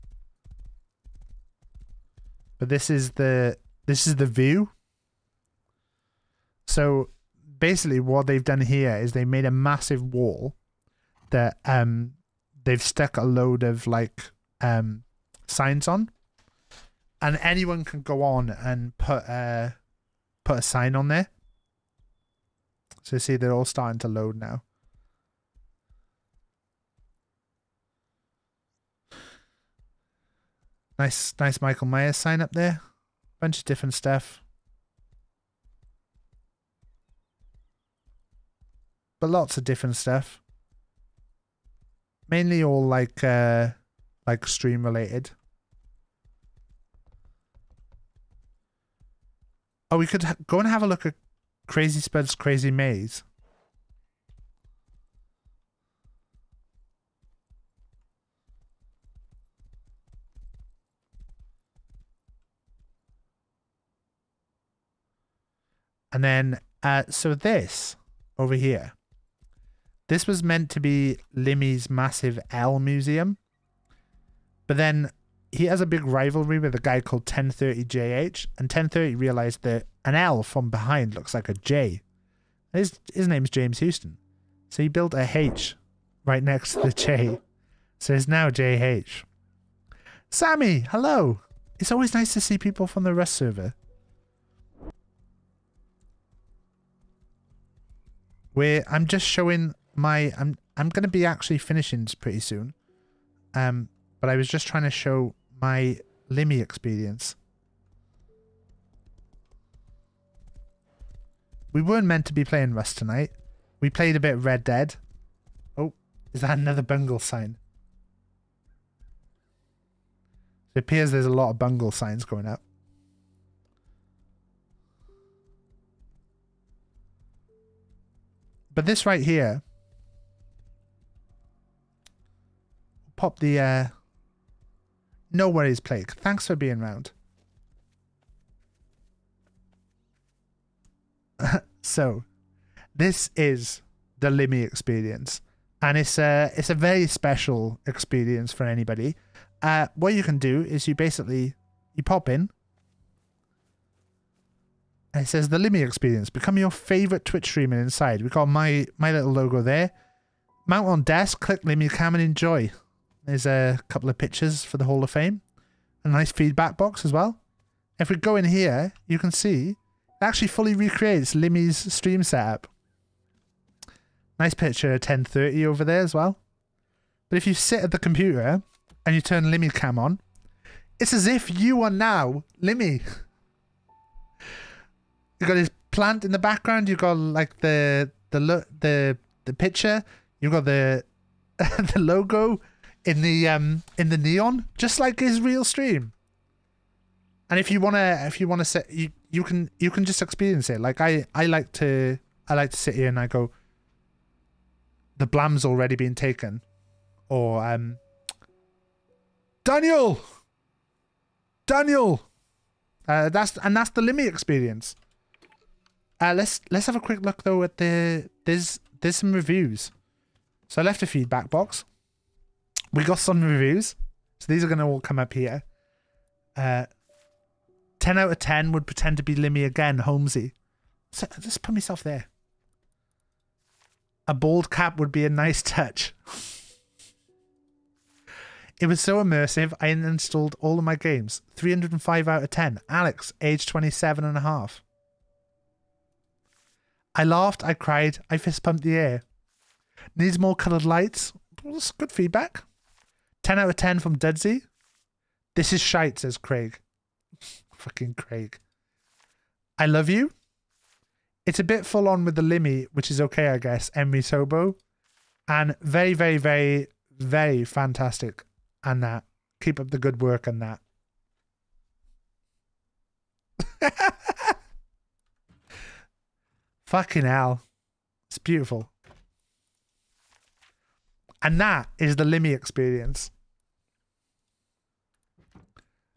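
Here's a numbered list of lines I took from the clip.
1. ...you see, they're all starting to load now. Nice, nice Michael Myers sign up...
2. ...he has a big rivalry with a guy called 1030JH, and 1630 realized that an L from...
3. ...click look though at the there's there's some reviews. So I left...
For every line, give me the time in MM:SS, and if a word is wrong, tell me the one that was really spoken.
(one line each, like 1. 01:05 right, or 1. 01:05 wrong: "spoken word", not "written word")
1. 00:23 right
2. 01:15 wrong: "1030", not "1630"
3. 03:36 wrong: "quick", not "click".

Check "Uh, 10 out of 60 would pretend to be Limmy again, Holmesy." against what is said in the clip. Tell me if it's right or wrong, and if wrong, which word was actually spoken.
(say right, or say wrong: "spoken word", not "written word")
wrong: "10", not "60".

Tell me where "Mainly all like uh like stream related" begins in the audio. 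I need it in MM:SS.
00:42.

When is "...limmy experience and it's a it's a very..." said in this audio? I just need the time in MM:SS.
02:24.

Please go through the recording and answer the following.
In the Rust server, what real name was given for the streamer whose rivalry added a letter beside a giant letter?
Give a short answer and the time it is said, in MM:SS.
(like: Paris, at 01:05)
James Houston, at 01:23.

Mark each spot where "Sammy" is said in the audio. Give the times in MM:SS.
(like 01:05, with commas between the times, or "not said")
01:30.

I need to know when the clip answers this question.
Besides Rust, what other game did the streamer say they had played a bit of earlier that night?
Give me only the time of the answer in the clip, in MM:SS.
01:54.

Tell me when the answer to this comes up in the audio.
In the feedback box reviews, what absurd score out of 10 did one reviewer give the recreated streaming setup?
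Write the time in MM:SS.
04:01.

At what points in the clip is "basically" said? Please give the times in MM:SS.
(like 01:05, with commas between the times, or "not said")
00:07, 02:30.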